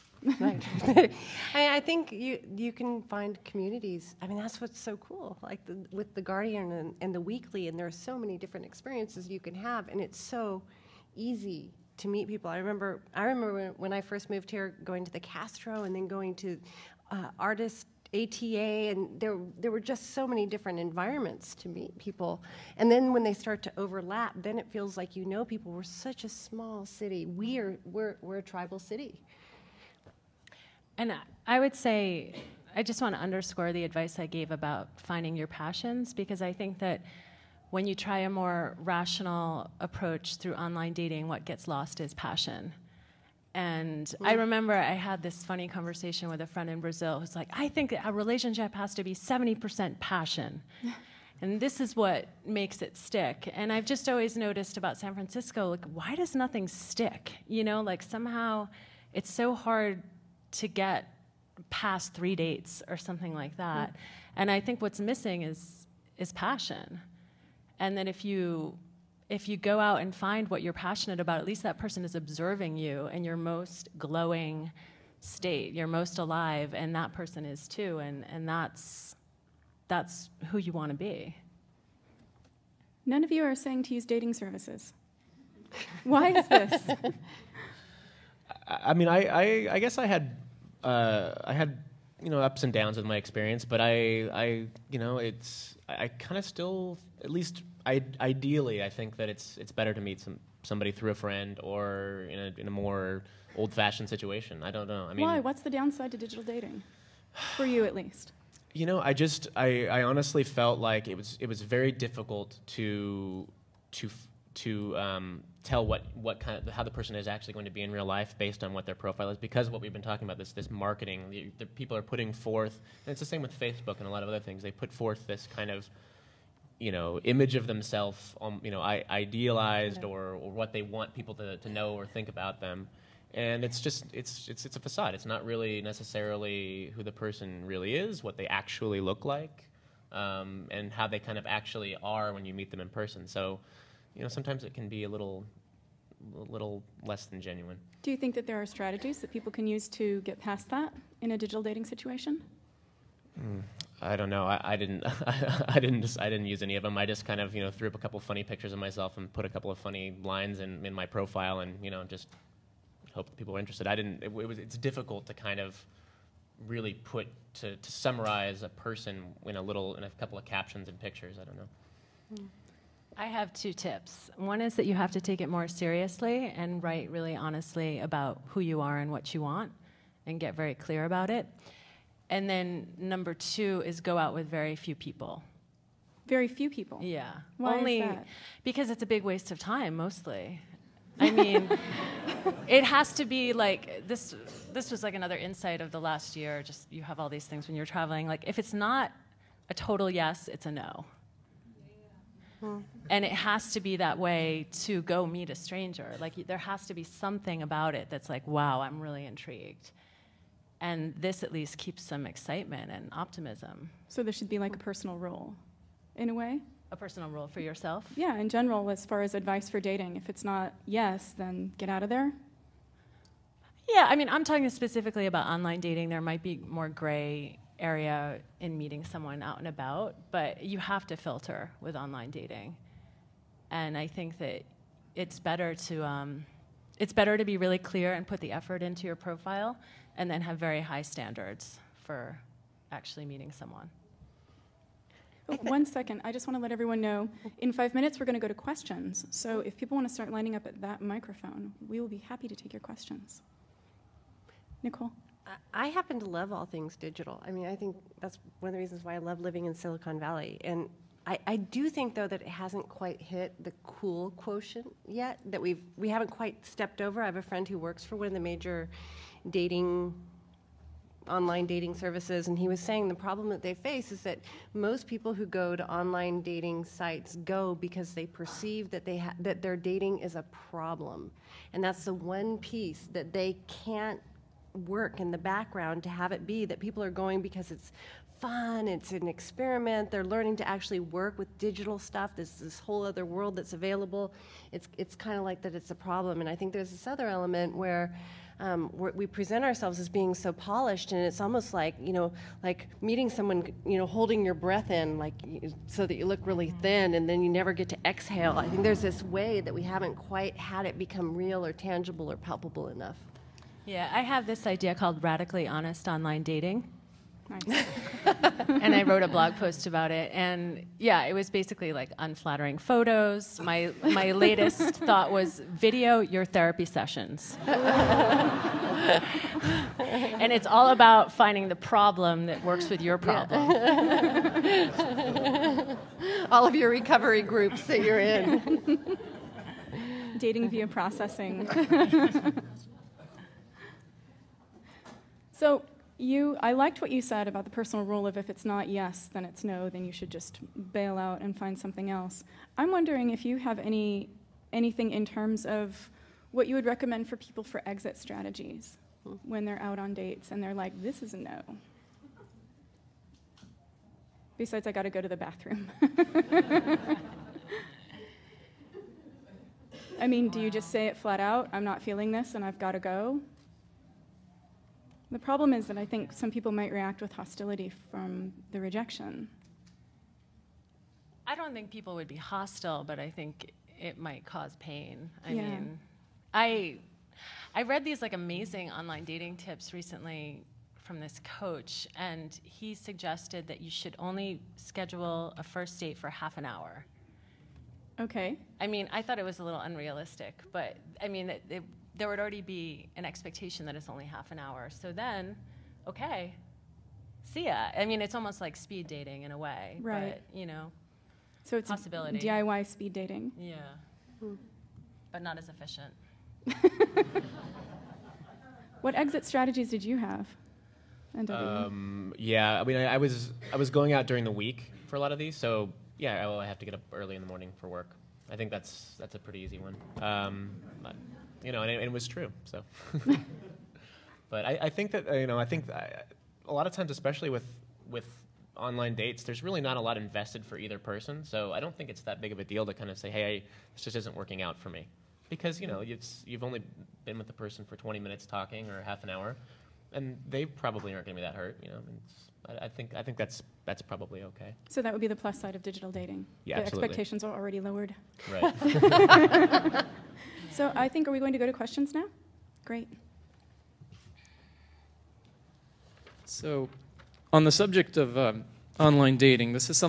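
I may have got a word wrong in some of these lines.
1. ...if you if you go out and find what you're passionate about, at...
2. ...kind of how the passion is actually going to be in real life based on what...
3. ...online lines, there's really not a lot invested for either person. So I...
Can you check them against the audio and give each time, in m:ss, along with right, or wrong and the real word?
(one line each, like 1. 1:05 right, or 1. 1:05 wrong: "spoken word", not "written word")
1. 1:08 right
2. 1:56 wrong: "person", not "passion"
3. 7:18 wrong: "dates", not "lines".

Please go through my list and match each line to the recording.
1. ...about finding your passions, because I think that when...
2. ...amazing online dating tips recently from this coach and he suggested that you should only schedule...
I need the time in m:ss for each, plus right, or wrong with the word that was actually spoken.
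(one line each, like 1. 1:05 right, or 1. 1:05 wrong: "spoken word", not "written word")
1. 0:34 right
2. 6:28 right.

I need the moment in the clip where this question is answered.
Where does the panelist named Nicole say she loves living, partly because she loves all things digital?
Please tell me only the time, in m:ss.
4:19.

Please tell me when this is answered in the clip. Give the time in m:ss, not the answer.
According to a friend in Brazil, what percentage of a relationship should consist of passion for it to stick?
0:49.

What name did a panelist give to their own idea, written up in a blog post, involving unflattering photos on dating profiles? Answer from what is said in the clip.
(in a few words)
radically honest online dating.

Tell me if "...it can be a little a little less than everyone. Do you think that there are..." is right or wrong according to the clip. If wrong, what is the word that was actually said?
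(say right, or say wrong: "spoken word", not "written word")
wrong: "genuine", not "everyone".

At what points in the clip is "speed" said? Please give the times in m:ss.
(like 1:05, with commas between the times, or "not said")
6:48, 6:52.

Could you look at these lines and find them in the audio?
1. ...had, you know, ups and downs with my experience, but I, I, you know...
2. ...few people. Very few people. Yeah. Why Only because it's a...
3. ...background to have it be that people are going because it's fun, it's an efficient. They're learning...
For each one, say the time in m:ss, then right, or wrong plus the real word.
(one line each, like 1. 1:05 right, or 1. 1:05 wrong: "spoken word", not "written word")
1. 1:31 right
2. 3:04 right
3. 4:45 wrong: "experiment", not "efficient".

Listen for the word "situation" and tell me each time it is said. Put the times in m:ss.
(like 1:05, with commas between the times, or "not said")
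1:44, 2:31.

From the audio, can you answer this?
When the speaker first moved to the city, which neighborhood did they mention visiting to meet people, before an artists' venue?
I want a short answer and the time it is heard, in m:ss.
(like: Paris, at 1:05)
the Castro, at 0:15.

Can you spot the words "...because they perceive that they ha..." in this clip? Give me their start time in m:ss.
4:37.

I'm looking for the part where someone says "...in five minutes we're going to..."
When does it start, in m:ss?
4:07.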